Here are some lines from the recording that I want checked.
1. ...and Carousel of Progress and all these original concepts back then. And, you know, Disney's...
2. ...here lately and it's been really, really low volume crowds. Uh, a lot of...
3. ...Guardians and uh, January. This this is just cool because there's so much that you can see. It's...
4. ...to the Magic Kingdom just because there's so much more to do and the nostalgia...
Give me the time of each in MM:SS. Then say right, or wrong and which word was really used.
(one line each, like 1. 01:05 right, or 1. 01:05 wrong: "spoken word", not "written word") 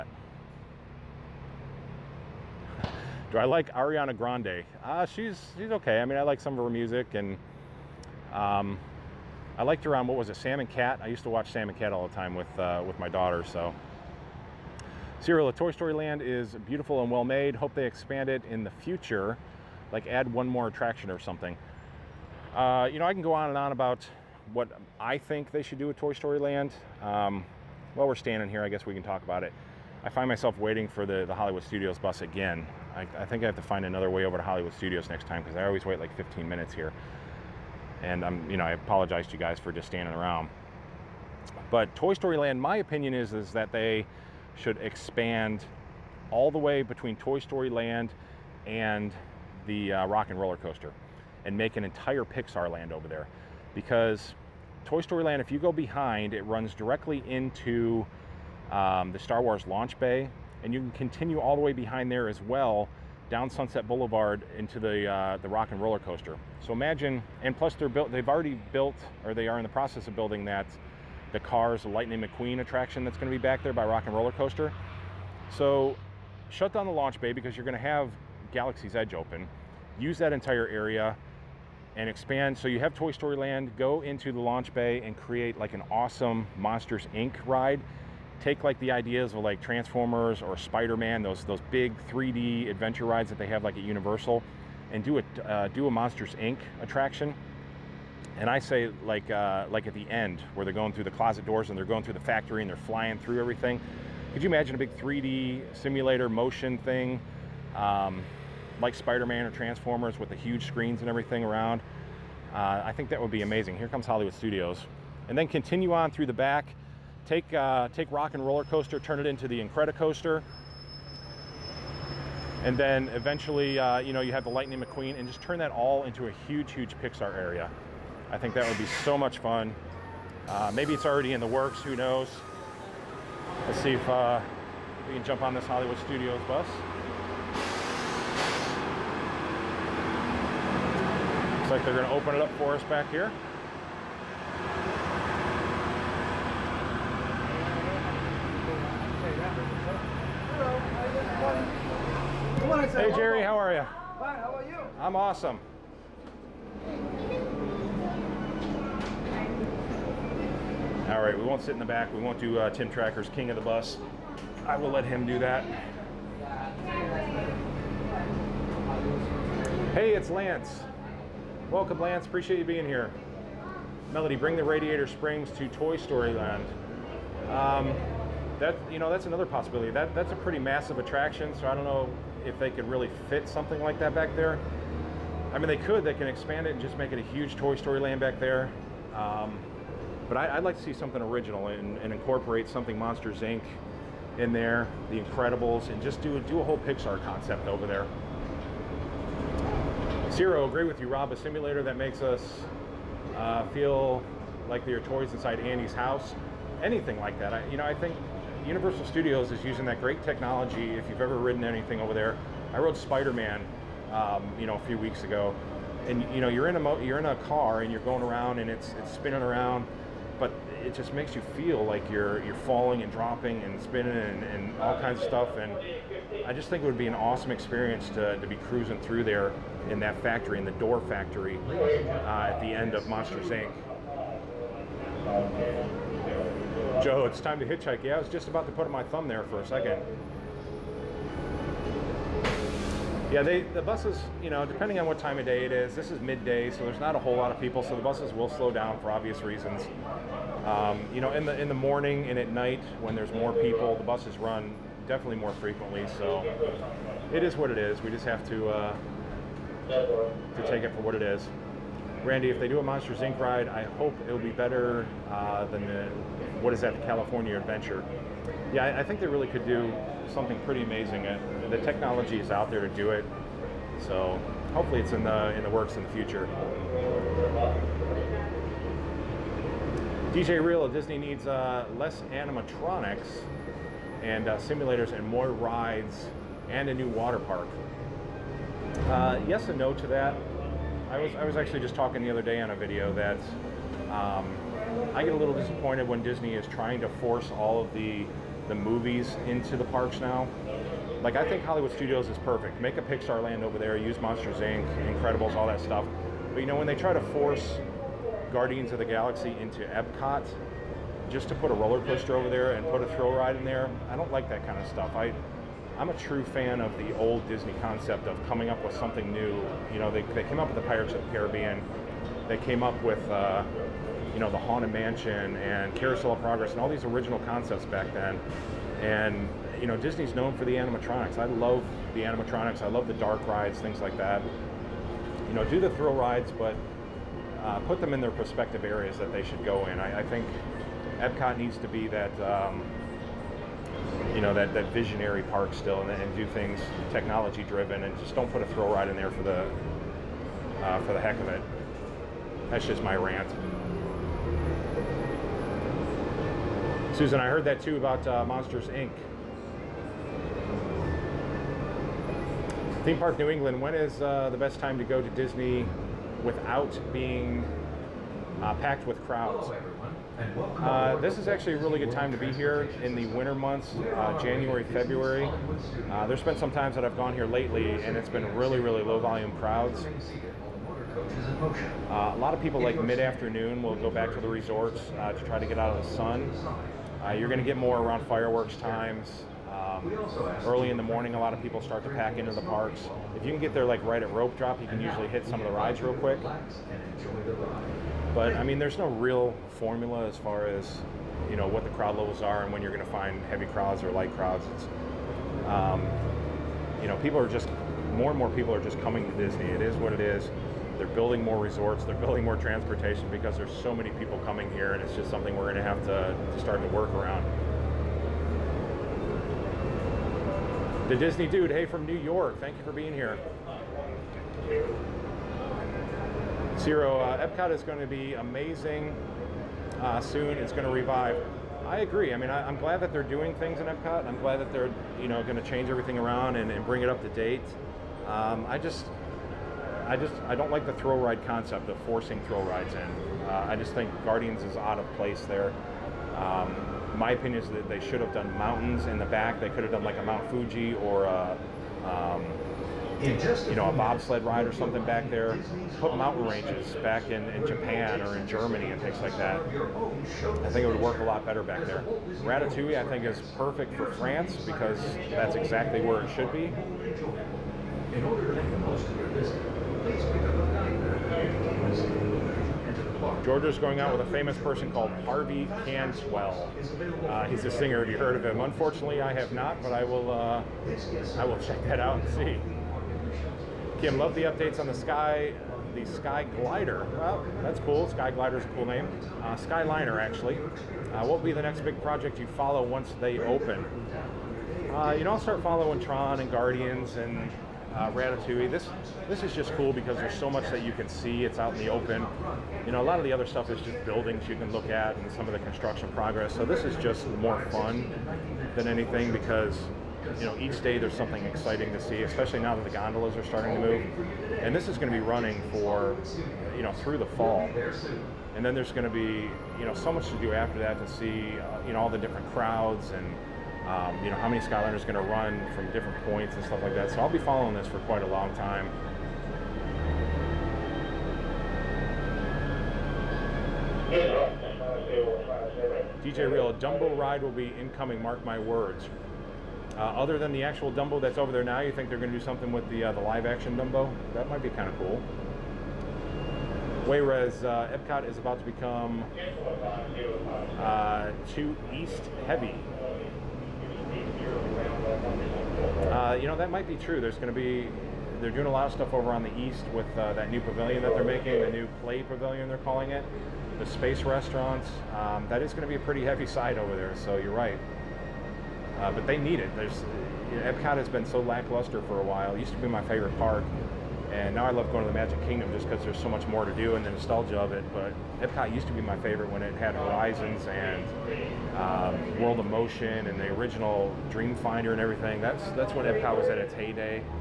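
1. 05:25 right
2. 06:17 right
3. 08:16 wrong: "Ratatouille", not "January"
4. 09:35 right.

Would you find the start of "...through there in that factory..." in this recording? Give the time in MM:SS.
03:48.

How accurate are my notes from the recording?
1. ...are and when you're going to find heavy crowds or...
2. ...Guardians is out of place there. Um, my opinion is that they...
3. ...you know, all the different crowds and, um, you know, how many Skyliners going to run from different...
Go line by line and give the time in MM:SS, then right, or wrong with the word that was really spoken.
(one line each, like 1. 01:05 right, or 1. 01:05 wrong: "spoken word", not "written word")
1. 06:42 right
2. 07:24 right
3. 08:41 right.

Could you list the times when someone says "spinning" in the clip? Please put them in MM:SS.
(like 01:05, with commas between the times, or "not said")
03:39, 03:43.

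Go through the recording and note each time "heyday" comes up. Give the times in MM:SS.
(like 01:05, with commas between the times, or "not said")
09:46.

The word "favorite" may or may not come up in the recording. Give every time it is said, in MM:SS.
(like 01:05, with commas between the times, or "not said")
09:33, 09:39.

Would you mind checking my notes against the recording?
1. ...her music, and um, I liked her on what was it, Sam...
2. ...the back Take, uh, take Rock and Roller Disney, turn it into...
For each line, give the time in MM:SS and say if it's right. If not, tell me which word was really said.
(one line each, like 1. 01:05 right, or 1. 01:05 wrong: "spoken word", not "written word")
1. 00:06 right
2. 01:56 wrong: "Coaster", not "Disney".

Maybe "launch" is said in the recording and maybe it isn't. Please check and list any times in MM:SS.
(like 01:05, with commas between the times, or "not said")
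00:59, 01:16, 01:24.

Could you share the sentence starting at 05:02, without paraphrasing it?
Make a Pixar land over there.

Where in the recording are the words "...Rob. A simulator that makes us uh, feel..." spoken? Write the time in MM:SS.
03:21.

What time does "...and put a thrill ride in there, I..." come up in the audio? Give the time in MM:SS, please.
05:12.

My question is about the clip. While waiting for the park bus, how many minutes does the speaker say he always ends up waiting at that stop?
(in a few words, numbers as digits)
15.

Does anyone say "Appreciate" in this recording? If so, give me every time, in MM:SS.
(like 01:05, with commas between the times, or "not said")
02:52.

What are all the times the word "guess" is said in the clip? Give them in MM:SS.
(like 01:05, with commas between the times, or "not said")
00:28.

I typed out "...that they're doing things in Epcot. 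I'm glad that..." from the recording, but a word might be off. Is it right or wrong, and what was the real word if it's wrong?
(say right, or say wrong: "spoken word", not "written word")
right.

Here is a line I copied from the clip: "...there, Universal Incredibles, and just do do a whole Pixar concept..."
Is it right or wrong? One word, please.
wrong.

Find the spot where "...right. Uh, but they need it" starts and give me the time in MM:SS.
09:27.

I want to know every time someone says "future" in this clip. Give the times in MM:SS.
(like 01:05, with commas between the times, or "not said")
00:18, 04:36.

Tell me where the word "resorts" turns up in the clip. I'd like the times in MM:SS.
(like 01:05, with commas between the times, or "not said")
06:24, 06:51.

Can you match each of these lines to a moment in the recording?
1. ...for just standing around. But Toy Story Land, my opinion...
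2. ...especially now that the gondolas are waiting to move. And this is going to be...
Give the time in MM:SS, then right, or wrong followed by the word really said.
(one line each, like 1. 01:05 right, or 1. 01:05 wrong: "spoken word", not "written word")
1. 00:39 right
2. 08:32 wrong: "starting", not "waiting".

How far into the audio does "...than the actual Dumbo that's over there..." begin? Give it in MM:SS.
09:00.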